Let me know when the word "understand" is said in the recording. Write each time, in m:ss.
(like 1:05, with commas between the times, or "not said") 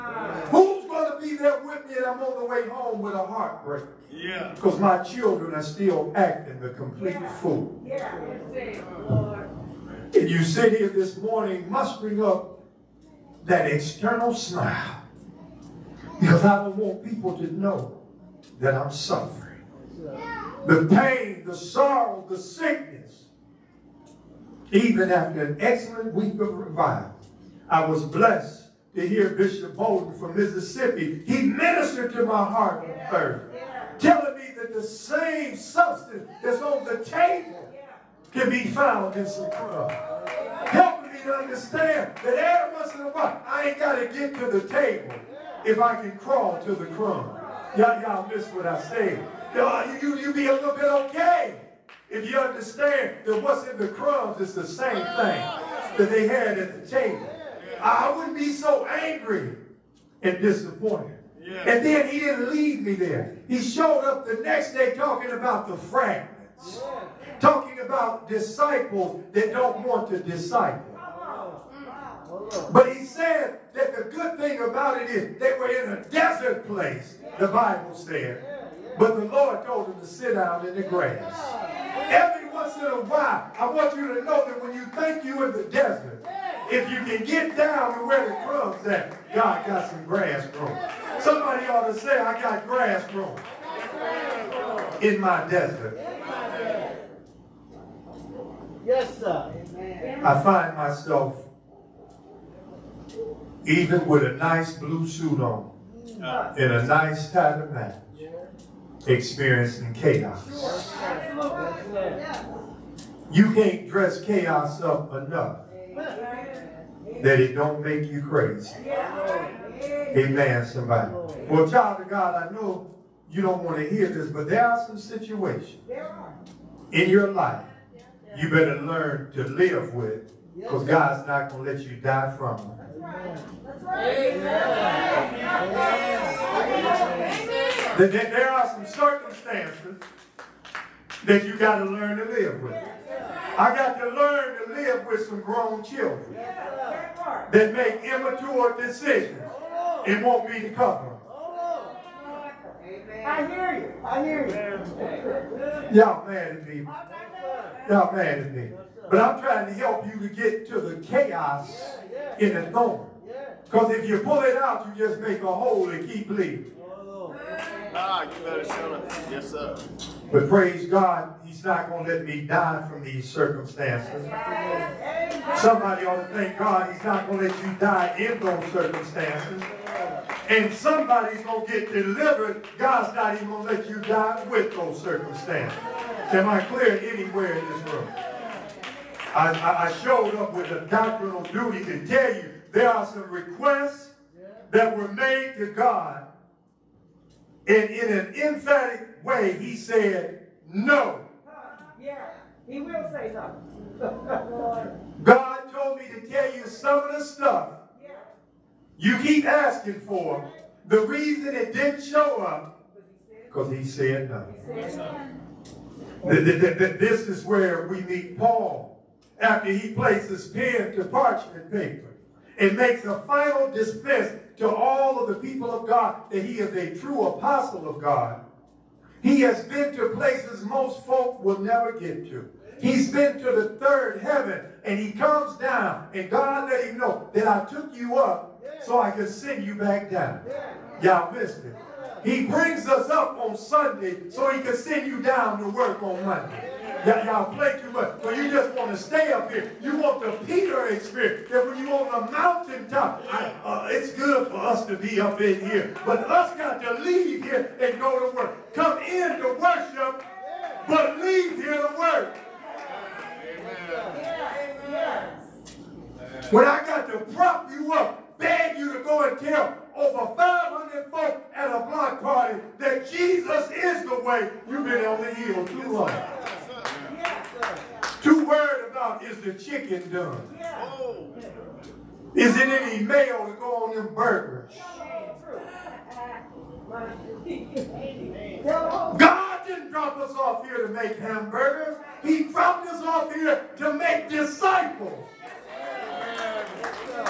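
0:41, 0:52.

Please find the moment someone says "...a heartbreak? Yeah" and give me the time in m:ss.
0:03.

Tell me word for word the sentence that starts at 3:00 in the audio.
And somebody's going to get delivered.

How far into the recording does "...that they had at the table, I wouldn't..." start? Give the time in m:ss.
0:55.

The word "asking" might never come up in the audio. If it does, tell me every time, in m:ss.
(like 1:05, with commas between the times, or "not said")
3:29.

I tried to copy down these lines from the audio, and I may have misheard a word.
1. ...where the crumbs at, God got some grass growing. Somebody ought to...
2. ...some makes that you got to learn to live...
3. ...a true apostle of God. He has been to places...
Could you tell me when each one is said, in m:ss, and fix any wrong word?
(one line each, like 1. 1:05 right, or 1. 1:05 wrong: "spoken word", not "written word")
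1. 1:28 right
2. 2:18 wrong: "circumstances", not "makes"
3. 3:46 right.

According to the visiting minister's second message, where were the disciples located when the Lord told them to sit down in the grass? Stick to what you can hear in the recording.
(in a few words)
A desert place.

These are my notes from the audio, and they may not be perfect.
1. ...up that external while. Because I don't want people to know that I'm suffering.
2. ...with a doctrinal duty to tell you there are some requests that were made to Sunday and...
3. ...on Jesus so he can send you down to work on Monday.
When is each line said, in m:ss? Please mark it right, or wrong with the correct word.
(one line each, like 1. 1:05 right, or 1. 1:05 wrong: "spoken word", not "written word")
1. 0:12 wrong: "smile", not "while"
2. 3:10 wrong: "God", not "Sunday"
3. 4:03 wrong: "Sunday", not "Jesus".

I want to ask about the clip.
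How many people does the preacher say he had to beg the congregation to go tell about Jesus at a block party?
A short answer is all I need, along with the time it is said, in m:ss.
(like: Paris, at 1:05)
500, at 4:30.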